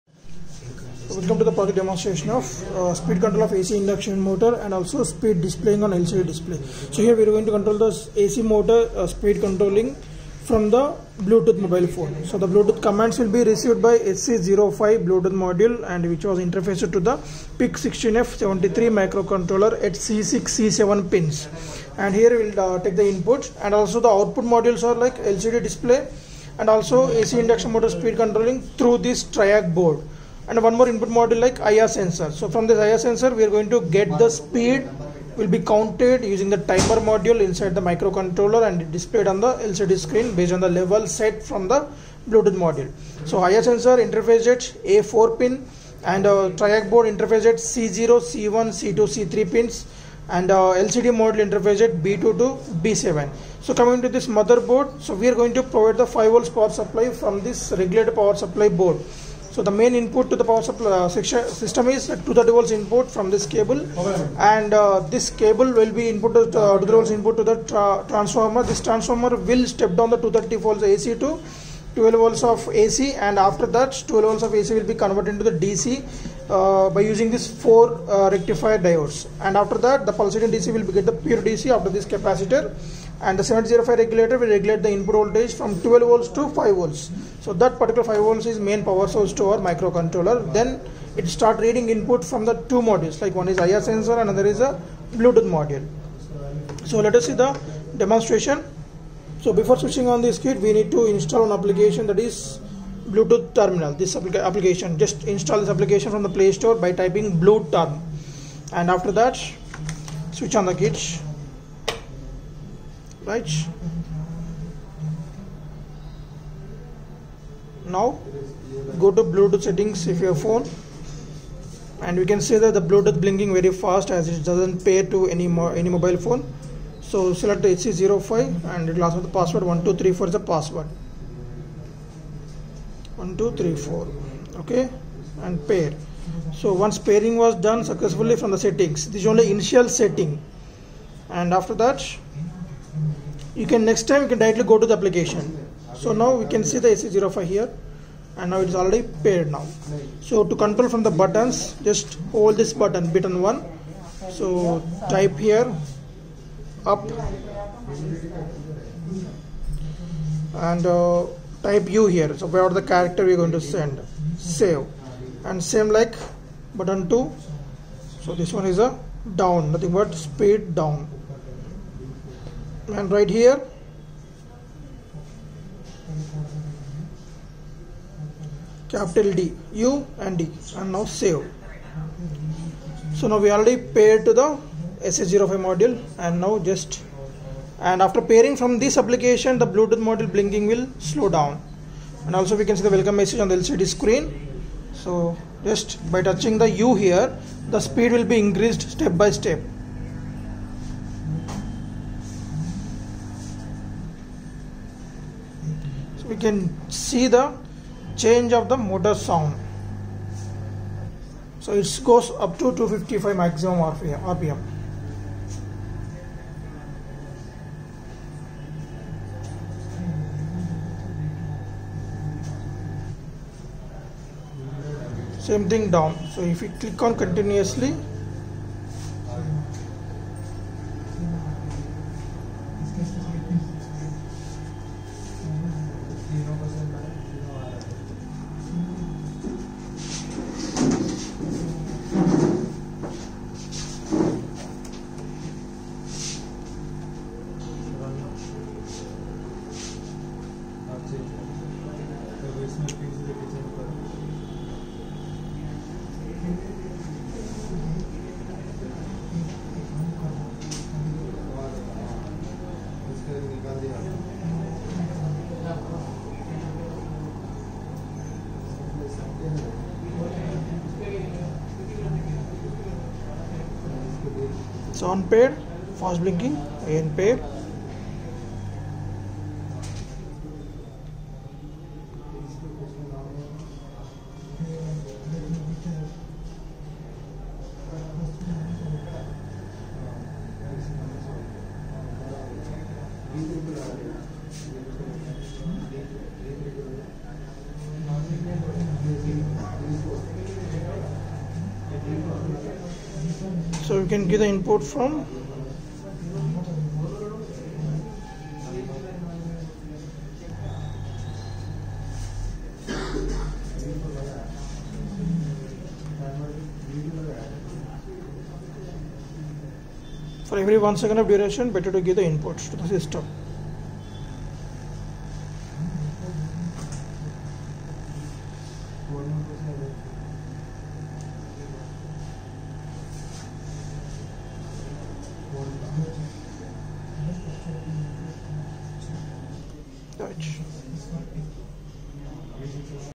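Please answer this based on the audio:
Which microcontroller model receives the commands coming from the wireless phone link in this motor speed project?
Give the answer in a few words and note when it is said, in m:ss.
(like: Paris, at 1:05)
PIC16F73, at 0:17.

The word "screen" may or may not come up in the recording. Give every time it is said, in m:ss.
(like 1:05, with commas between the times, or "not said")
0:39, 3:13.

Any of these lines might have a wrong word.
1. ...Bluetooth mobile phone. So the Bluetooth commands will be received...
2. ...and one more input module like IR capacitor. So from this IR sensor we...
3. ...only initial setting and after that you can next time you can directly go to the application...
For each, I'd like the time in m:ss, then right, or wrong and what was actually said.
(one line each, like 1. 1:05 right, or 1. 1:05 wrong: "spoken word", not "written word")
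1. 0:11 right
2. 0:30 wrong: "sensor", not "capacitor"
3. 2:19 right.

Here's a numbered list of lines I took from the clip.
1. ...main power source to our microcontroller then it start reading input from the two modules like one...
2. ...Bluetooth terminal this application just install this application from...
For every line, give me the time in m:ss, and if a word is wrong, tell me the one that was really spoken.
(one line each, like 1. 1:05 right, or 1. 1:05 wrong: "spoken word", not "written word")
1. 1:28 right
2. 1:43 right.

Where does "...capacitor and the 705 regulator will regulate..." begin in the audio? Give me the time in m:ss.
1:22.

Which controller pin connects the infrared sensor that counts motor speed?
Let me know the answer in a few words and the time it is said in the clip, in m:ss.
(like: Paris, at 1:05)
A4, at 0:44.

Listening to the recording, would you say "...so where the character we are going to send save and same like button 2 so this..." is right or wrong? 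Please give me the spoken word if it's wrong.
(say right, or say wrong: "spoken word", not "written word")
right.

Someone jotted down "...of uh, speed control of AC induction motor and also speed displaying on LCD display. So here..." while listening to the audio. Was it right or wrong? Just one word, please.
right.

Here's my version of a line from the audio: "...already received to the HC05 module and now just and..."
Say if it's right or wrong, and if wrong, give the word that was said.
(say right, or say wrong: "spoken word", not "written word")
wrong: "paired", not "received".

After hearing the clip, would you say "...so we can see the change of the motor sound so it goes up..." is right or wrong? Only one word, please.
right.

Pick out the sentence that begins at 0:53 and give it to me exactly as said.
So coming to this motherboard, so we are going to provide the 5 volts power supply from this regulated power supply board.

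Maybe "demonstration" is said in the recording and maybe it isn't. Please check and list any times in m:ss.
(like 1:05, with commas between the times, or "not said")
0:01, 1:37.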